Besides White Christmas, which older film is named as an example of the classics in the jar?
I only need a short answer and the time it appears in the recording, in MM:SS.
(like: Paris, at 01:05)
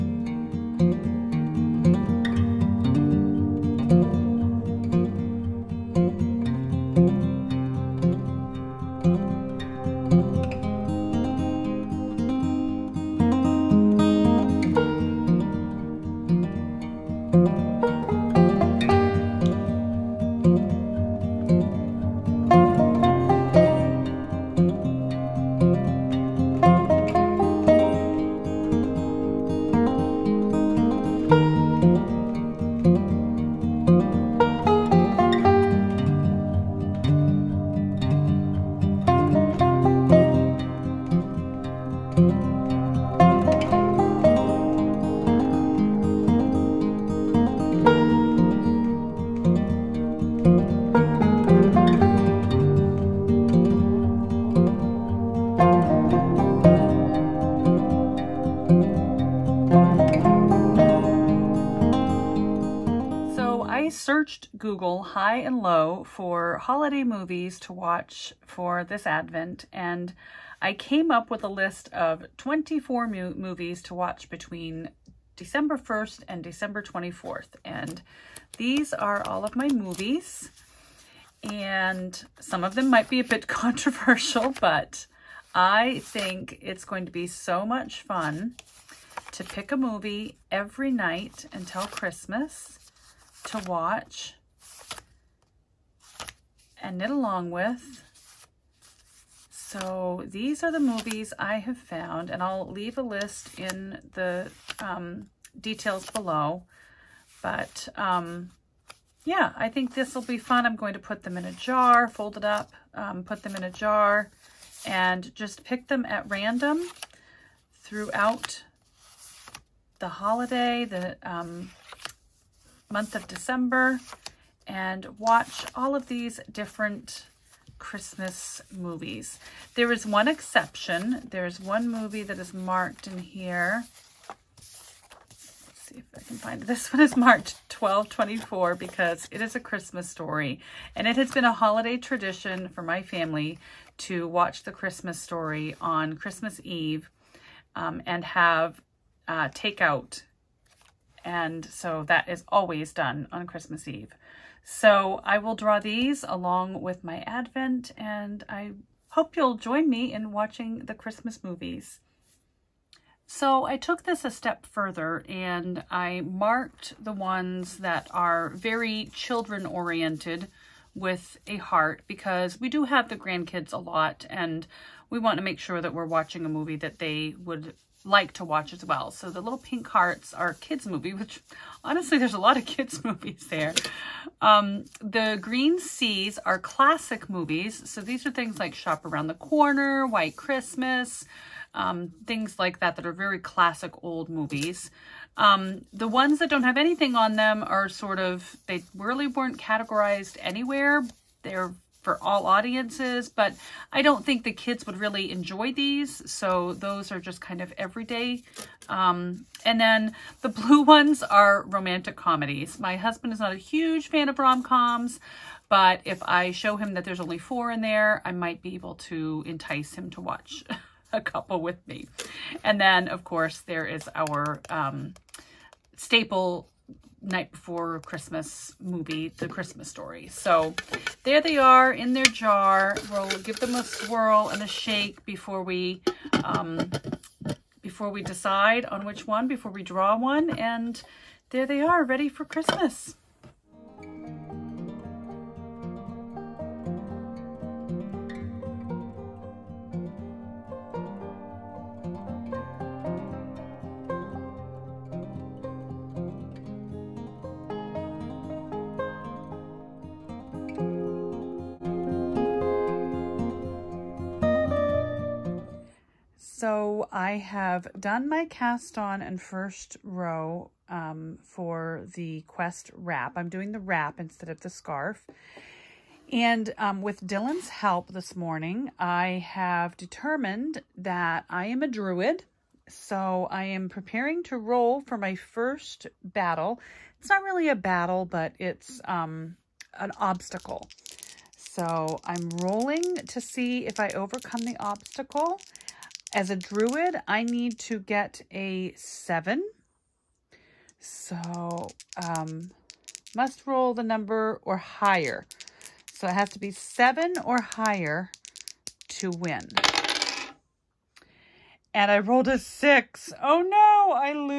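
Shop Around the Corner, at 03:08.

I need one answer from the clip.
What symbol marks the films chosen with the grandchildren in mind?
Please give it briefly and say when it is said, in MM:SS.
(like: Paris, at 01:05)
a heart, at 02:51.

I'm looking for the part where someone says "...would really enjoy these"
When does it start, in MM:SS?
03:24.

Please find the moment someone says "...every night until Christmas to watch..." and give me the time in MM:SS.
01:30.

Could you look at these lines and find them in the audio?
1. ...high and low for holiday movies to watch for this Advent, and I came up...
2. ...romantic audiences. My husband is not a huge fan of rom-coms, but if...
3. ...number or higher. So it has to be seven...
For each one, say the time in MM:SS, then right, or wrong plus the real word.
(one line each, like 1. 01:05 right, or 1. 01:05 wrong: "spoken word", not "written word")
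1. 01:05 right
2. 03:31 wrong: "comedies", not "audiences"
3. 05:04 right.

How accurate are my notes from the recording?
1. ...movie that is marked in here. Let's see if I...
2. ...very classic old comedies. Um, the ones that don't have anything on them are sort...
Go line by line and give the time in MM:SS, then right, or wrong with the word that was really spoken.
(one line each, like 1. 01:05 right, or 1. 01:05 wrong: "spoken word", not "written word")
1. 02:11 right
2. 03:13 wrong: "movies", not "comedies".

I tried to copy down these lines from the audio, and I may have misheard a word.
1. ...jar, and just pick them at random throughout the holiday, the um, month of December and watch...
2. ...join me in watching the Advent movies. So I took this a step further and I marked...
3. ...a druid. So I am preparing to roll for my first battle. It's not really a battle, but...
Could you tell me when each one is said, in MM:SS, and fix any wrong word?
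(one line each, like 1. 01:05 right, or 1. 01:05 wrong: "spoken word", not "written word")
1. 01:53 right
2. 02:39 wrong: "Christmas", not "Advent"
3. 04:41 right.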